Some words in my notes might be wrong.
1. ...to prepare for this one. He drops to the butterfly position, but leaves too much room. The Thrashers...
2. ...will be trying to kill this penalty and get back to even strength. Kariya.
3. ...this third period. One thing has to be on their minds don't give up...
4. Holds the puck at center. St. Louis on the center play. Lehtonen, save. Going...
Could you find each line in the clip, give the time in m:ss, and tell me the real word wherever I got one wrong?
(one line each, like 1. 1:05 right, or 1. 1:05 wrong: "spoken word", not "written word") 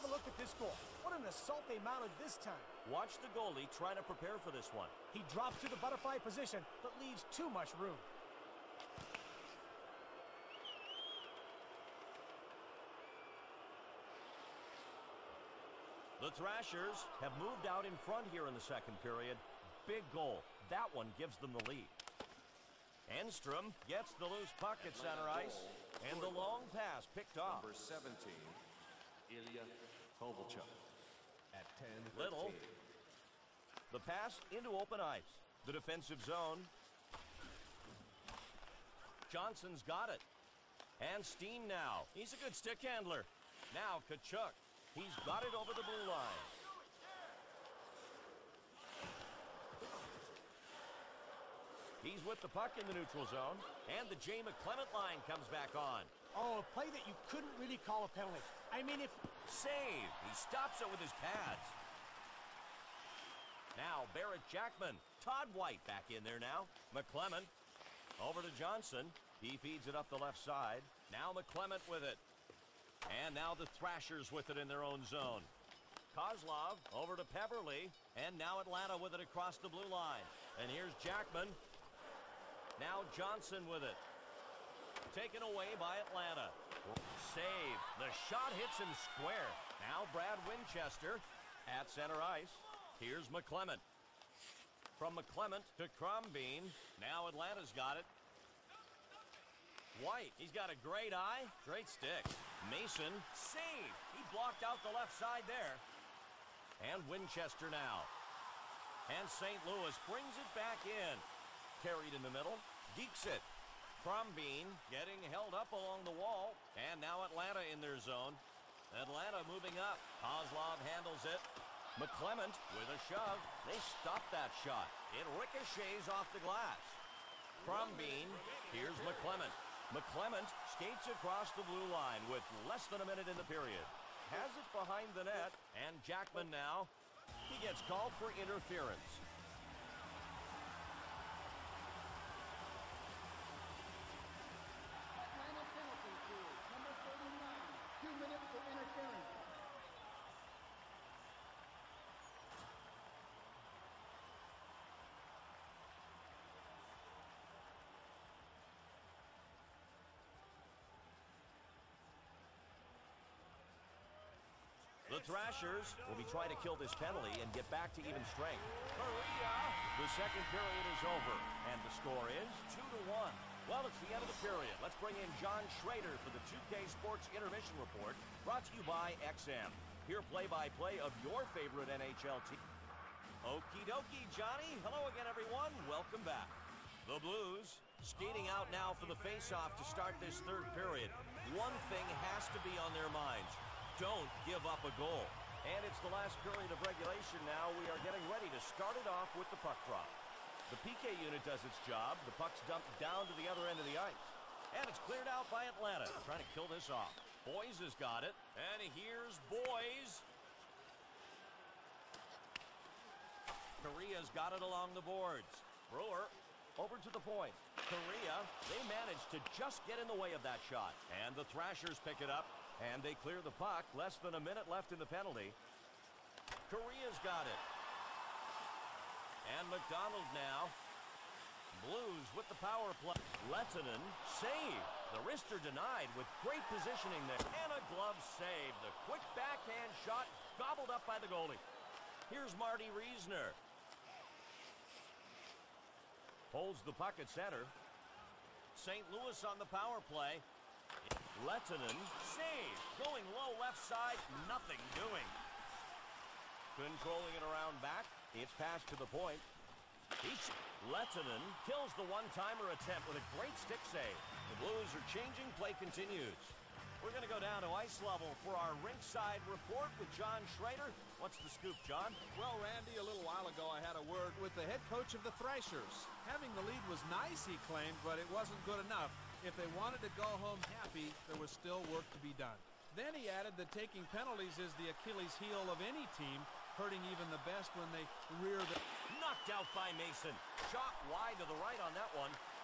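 1. 0:03 right
2. 2:46 right
3. 3:10 right
4. 4:06 wrong: "power", not "center".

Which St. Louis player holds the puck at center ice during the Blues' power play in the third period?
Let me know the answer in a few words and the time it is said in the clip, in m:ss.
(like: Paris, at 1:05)
Marty Reasoner, at 4:02.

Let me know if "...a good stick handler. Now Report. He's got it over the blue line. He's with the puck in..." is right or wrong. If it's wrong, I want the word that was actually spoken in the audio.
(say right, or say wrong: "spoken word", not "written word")
wrong: "Tkachuk", not "Report".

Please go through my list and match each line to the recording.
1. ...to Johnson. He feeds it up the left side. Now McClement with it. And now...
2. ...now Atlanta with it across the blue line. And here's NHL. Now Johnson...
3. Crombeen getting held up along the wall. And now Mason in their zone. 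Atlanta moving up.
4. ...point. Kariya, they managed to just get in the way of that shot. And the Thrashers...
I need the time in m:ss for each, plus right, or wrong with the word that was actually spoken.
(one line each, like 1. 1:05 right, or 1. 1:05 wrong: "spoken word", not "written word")
1. 1:08 right
2. 1:18 wrong: "Jackman", not "NHL"
3. 1:54 wrong: "Atlanta", not "Mason"
4. 3:37 right.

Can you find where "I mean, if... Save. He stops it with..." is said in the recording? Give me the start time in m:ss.
0:58.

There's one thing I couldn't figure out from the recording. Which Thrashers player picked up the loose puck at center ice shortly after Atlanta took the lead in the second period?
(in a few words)
Enstrom.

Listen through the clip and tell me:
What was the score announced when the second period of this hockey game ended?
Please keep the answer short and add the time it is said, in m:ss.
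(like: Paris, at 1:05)
2 to 1, at 2:52.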